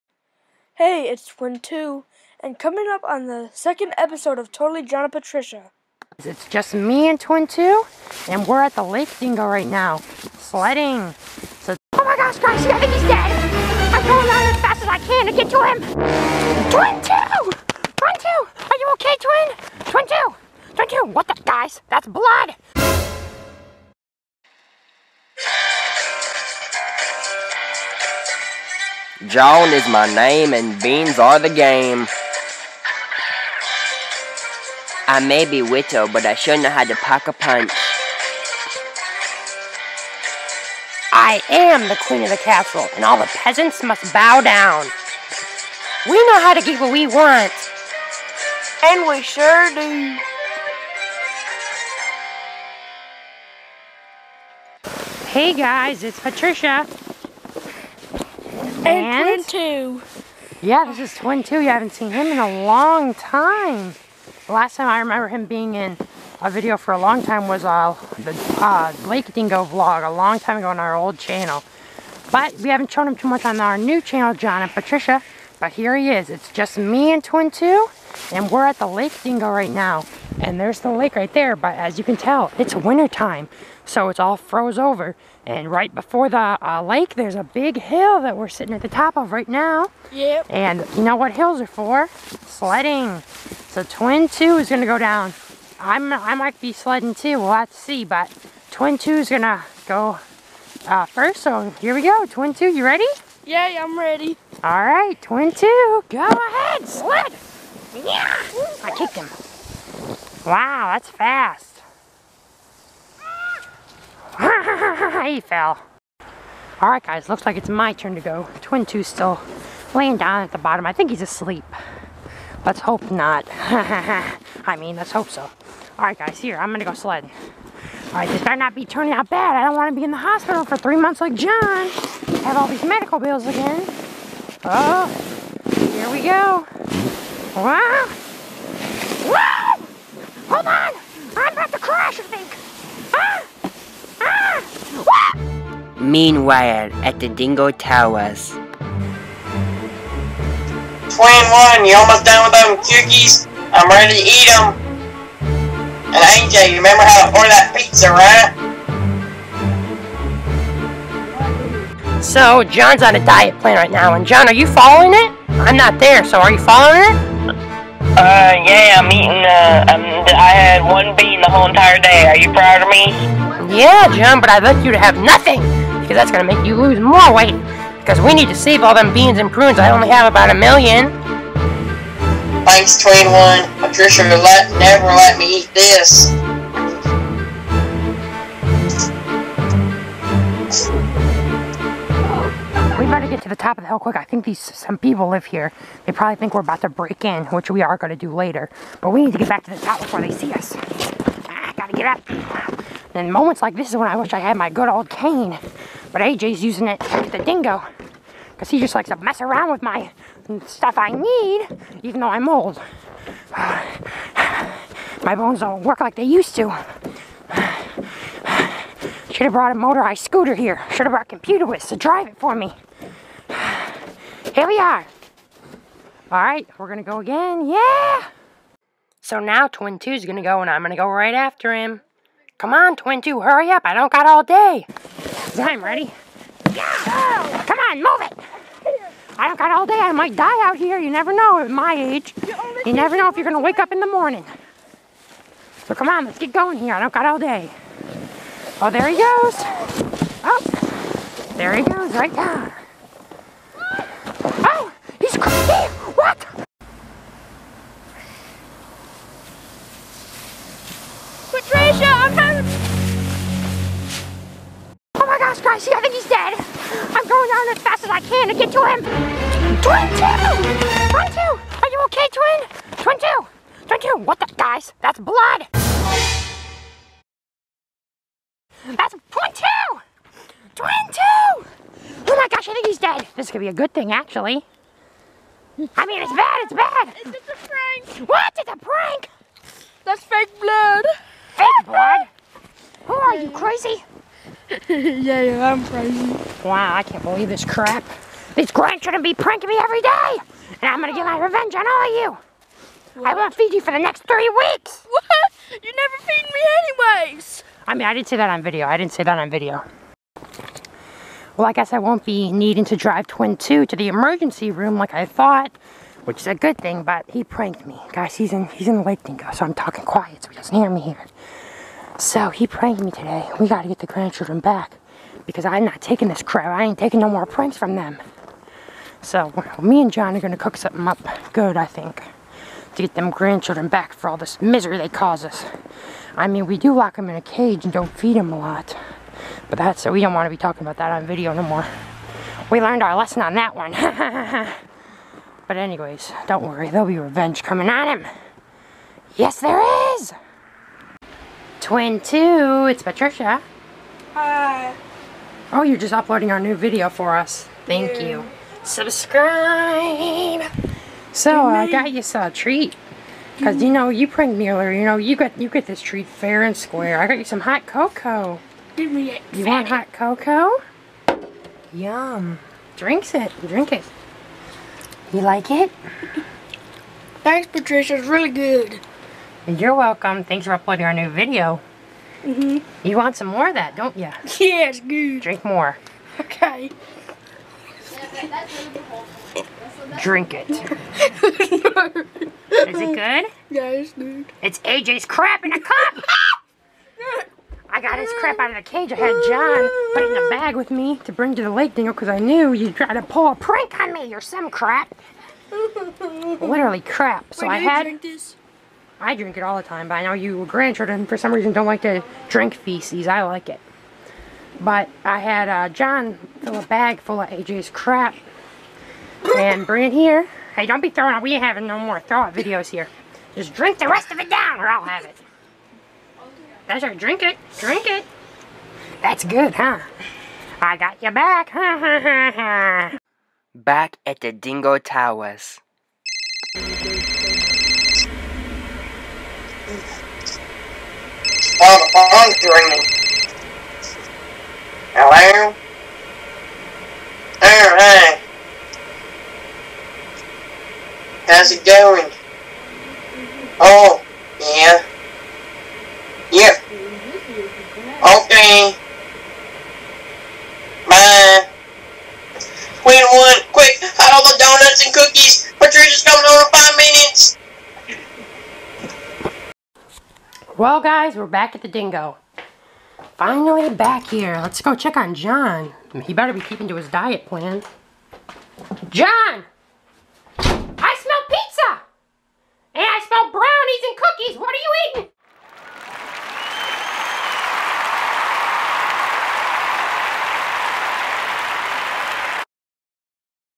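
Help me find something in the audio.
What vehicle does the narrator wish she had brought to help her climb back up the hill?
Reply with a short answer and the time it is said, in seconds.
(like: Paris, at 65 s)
motorized scooter, at 219 s.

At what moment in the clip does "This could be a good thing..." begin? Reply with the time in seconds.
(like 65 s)
283 s.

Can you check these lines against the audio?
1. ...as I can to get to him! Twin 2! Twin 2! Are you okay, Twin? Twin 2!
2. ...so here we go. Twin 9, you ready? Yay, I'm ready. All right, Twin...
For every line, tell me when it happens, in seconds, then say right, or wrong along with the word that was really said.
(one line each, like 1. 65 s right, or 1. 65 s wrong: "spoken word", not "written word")
1. 14 s right
2. 101 s wrong: "2", not "9".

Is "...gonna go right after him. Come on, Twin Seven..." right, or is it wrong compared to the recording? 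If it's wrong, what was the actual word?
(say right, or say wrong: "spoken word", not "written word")
wrong: "Two", not "Seven".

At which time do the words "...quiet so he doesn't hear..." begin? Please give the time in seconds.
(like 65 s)
320 s.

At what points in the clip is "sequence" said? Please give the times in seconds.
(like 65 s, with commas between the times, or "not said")
not said.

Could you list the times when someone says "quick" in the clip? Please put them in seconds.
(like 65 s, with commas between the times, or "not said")
193 s, 463 s.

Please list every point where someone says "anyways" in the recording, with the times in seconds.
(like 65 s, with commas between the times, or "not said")
307 s, 345 s.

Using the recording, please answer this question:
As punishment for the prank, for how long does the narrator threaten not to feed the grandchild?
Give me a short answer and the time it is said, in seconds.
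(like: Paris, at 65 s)
3 weeks, at 304 s.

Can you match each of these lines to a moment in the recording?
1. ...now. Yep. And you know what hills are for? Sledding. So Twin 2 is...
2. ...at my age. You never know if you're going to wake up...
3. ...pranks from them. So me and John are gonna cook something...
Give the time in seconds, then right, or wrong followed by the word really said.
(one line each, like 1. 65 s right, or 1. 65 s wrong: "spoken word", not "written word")
1. 89 s right
2. 241 s right
3. 327 s right.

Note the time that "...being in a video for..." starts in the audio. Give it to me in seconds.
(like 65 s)
65 s.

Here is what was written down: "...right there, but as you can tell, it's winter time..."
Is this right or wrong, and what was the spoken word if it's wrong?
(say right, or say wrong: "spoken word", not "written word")
right.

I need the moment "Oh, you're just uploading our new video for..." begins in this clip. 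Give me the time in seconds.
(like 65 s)
355 s.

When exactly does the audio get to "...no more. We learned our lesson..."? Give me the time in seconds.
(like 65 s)
341 s.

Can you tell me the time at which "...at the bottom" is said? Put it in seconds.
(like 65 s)
120 s.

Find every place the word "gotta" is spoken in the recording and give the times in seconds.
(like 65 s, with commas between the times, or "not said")
201 s, 323 s.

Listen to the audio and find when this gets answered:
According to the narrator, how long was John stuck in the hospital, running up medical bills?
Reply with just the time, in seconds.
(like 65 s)
130 s.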